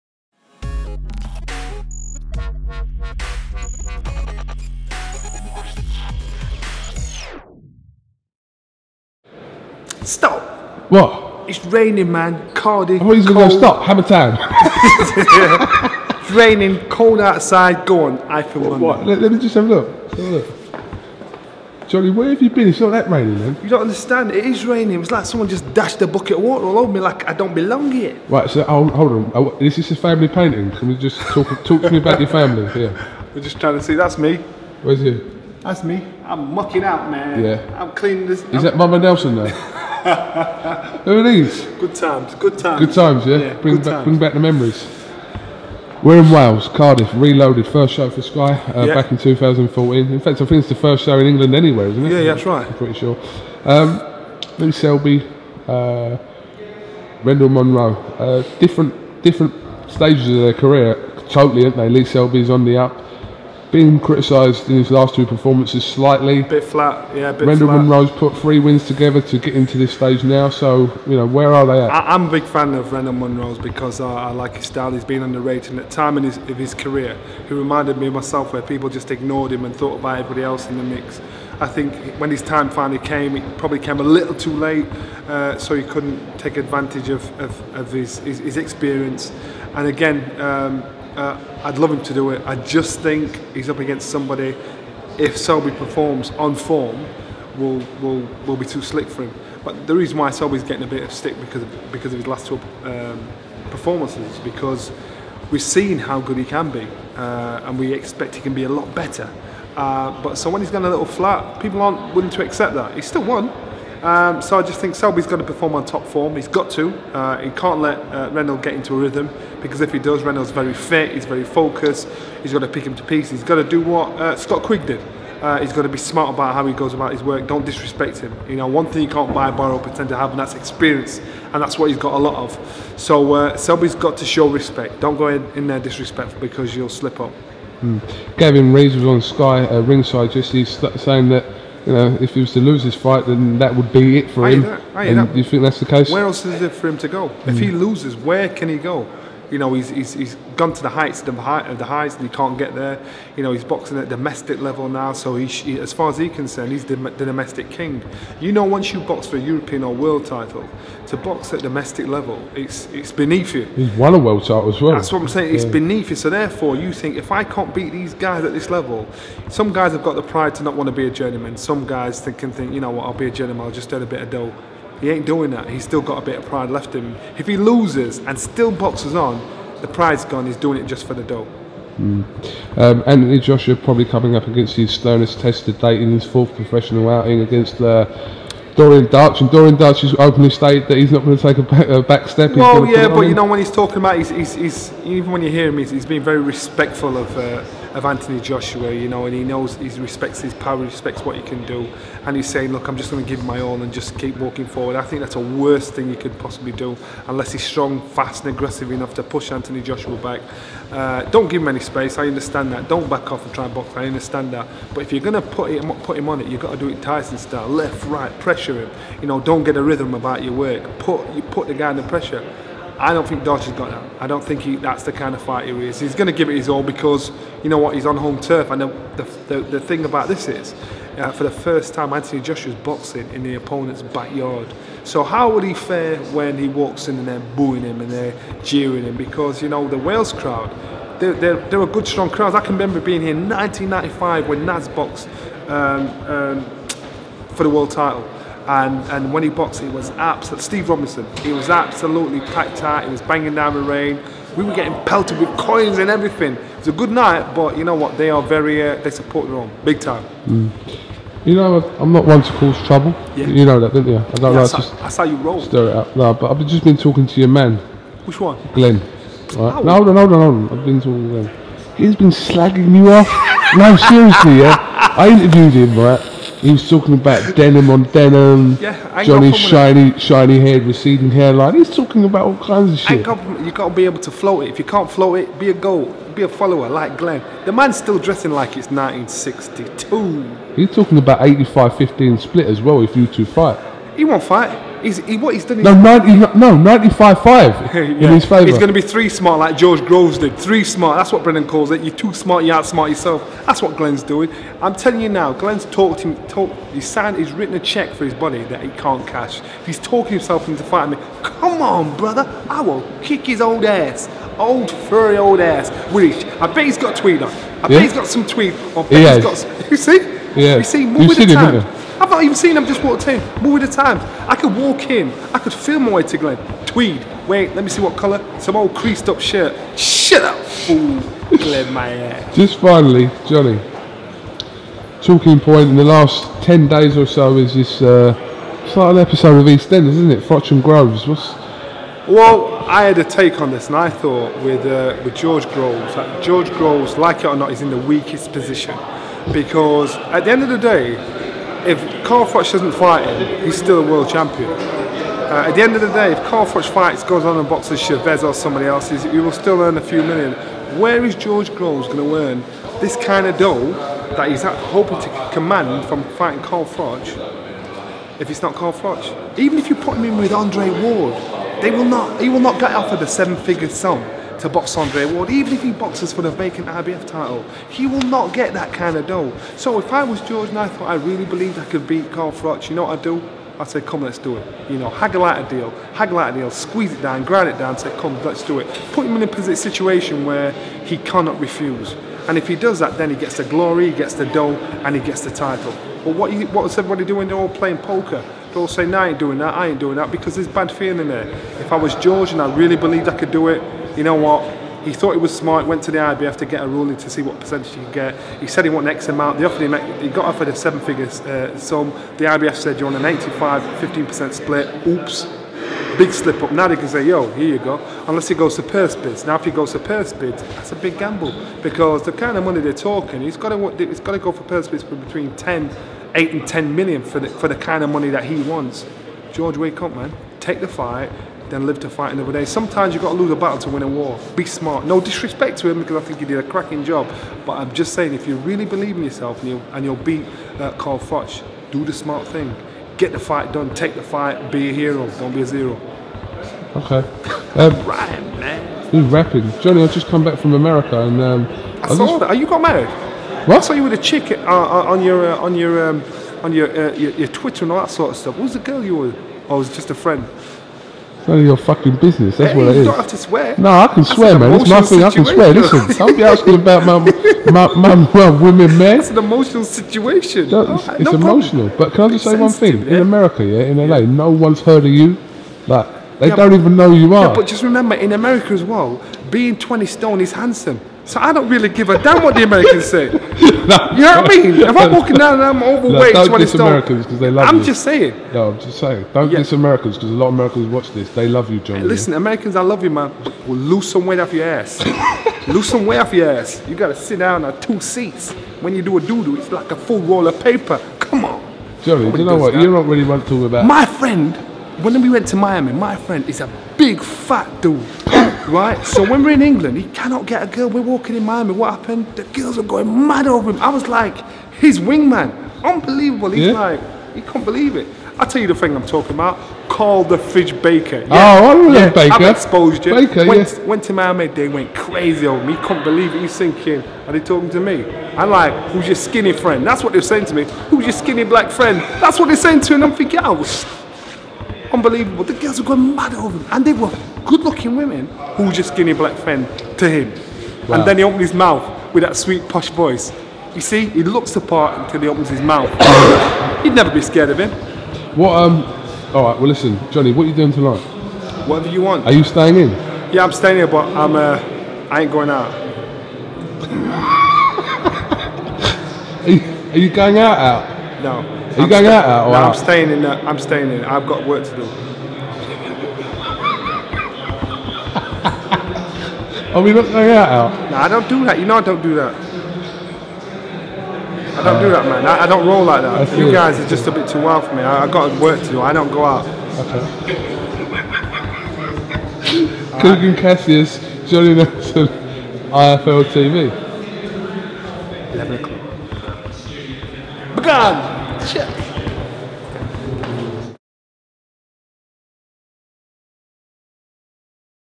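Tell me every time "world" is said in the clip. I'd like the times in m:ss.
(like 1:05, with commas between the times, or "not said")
2:39, 2:44, 4:07, 5:54.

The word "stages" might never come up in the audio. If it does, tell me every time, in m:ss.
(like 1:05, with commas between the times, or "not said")
0:59, 1:09.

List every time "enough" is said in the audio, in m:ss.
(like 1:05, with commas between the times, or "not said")
3:28.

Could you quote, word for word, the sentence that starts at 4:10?
Steve Robinson, he was absolutely packed out.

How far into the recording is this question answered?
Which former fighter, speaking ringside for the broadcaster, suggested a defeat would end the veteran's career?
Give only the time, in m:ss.
2:18.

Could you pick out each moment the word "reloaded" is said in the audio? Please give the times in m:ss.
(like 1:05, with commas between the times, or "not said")
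0:47.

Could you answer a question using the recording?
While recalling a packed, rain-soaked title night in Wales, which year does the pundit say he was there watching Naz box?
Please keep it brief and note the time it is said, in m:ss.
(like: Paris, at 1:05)
1995, at 4:03.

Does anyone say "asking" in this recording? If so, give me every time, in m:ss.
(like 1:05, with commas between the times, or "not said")
7:46.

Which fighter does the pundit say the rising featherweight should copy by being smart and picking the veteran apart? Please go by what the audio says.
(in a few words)
Scott Quigg.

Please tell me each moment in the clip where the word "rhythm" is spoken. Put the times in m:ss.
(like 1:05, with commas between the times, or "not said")
1:58, 3:39.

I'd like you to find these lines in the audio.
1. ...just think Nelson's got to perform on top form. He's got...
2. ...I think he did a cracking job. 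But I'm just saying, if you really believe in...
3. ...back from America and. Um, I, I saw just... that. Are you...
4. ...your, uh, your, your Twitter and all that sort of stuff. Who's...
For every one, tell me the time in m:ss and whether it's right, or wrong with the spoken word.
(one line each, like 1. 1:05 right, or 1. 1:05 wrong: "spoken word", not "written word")
1. 1:54 wrong: "Selby", not "Nelson"
2. 7:16 right
3. 7:30 right
4. 7:36 right.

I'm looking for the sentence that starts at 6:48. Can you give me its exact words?
He said he wanted X amount.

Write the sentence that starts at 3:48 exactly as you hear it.
And the, the, the, the thing about this is, uh, for the first time, Anthony Joshua's boxing in the opponent's backyard.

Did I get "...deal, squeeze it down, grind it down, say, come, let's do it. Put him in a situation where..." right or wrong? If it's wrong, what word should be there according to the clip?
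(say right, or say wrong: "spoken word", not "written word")
right.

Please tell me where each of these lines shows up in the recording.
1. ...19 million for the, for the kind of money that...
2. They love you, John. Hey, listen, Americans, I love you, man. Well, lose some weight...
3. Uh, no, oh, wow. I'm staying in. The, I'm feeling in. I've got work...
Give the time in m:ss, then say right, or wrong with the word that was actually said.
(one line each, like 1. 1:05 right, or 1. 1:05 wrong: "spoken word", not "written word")
1. 7:06 wrong: "10", not "19"
2. 8:11 right
3. 9:22 wrong: "staying", not "feeling".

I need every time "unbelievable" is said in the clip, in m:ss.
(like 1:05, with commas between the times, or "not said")
8:35, 8:54.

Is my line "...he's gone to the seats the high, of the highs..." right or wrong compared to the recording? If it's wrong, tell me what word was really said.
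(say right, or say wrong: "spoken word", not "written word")
wrong: "heights", not "seats".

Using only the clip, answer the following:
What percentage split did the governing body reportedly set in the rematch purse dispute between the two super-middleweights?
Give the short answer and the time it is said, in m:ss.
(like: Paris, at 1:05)
85-15, at 6:53.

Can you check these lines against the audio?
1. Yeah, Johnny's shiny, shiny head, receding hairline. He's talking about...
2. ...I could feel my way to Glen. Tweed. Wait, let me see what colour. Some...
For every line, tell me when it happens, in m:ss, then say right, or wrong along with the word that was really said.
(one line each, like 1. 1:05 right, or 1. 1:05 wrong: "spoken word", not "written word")
1. 4:38 right
2. 5:25 right.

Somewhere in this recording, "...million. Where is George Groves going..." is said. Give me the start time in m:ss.
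6:00.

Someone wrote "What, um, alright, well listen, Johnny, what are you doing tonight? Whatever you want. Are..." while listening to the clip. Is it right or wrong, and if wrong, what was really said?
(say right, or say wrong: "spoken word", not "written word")
right.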